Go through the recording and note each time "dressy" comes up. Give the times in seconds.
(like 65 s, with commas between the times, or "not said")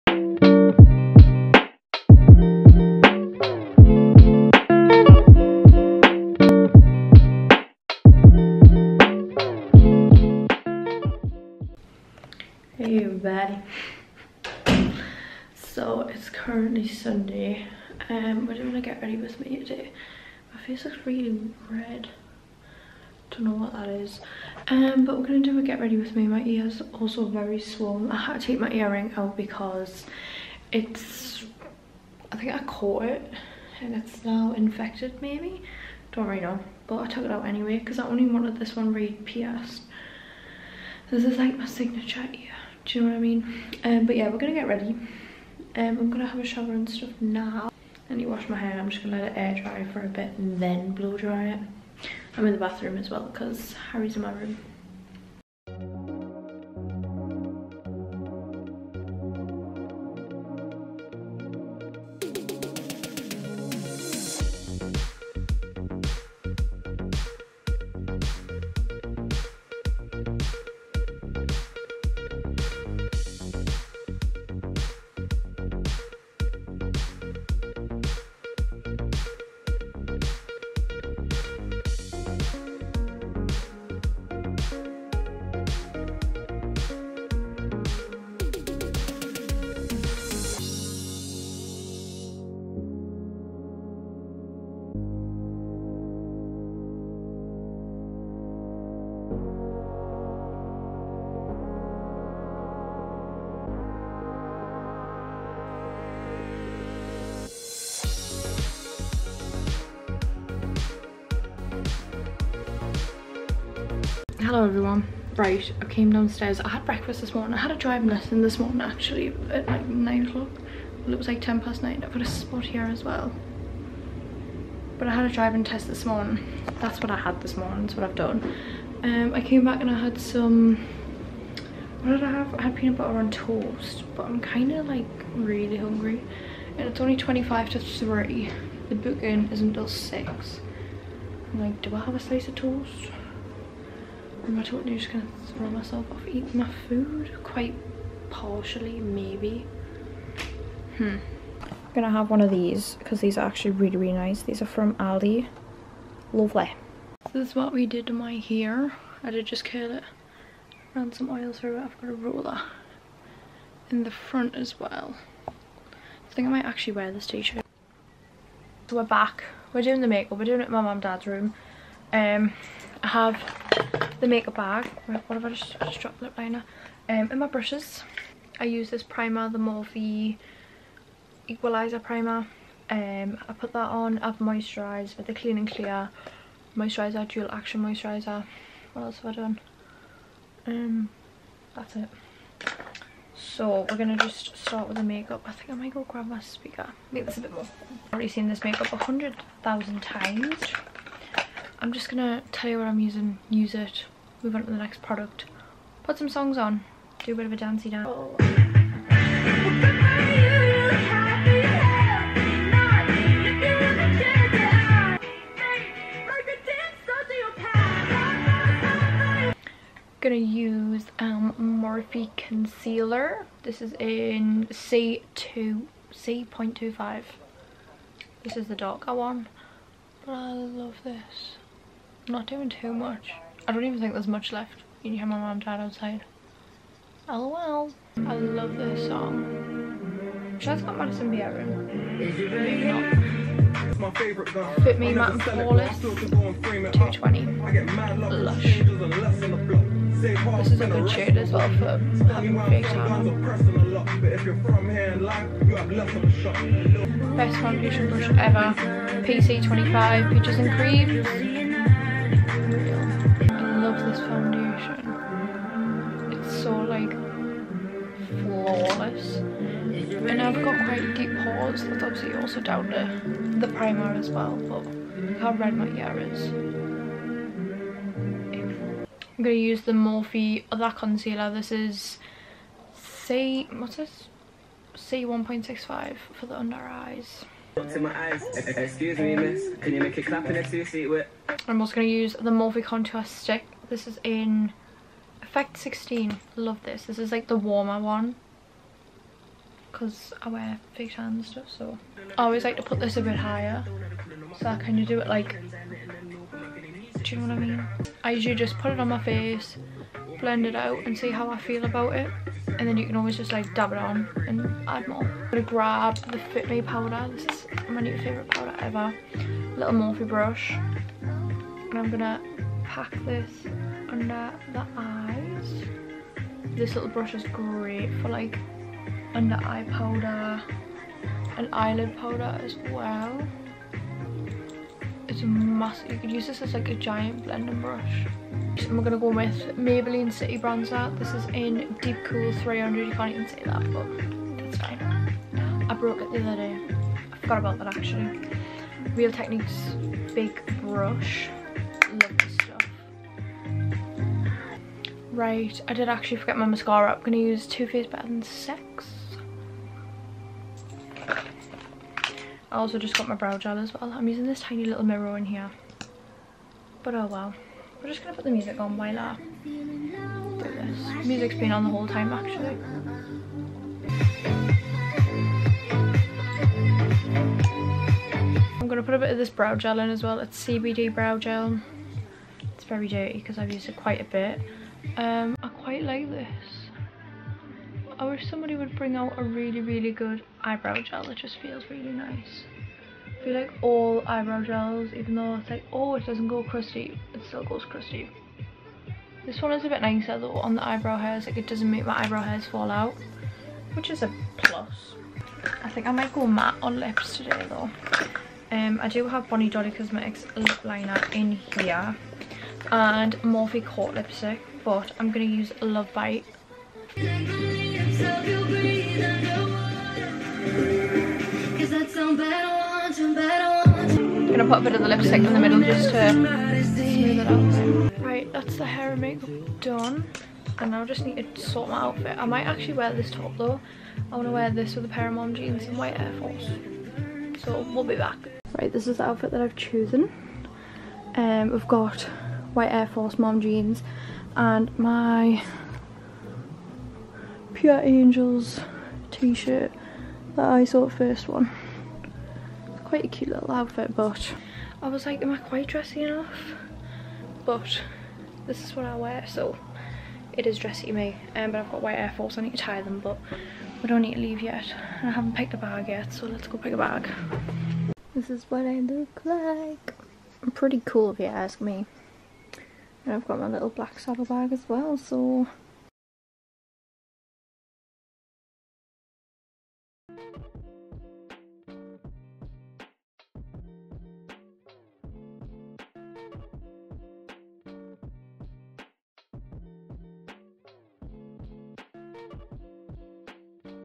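455 s, 460 s.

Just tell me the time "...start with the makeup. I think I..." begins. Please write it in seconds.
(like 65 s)
194 s.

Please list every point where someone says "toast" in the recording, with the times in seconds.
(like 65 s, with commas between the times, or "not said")
133 s, 142 s.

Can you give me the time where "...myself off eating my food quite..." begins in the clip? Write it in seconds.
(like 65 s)
145 s.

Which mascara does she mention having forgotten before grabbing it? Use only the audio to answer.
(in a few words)
Too Faced Better Than Sex.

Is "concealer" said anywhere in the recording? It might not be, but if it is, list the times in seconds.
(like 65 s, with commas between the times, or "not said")
222 s, 280 s.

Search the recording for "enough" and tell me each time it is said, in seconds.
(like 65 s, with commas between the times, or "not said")
456 s.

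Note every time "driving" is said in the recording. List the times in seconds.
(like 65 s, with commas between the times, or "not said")
117 s, 125 s.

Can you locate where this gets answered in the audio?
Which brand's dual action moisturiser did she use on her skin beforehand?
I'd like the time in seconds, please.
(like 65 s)
185 s.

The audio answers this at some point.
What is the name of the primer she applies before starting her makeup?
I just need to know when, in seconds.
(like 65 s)
179 s.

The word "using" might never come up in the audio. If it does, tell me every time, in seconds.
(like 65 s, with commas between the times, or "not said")
202 s, 364 s.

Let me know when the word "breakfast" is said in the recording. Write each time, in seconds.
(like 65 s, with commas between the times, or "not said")
116 s.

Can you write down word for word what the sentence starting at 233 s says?
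I don't even think there's much left.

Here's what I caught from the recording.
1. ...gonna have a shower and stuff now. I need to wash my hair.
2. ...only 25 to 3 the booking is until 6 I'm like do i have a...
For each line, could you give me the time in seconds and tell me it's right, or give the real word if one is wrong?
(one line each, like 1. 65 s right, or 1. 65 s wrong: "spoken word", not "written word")
1. 46 s right
2. 136 s right.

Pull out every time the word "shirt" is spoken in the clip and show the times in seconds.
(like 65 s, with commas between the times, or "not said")
167 s, 449 s.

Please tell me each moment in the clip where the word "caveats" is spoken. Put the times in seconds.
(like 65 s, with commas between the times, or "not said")
not said.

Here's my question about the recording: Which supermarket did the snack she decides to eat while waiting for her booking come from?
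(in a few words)
Aldi.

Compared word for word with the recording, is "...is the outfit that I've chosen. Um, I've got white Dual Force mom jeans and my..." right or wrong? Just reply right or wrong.
wrong.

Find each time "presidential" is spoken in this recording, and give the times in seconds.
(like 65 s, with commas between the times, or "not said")
not said.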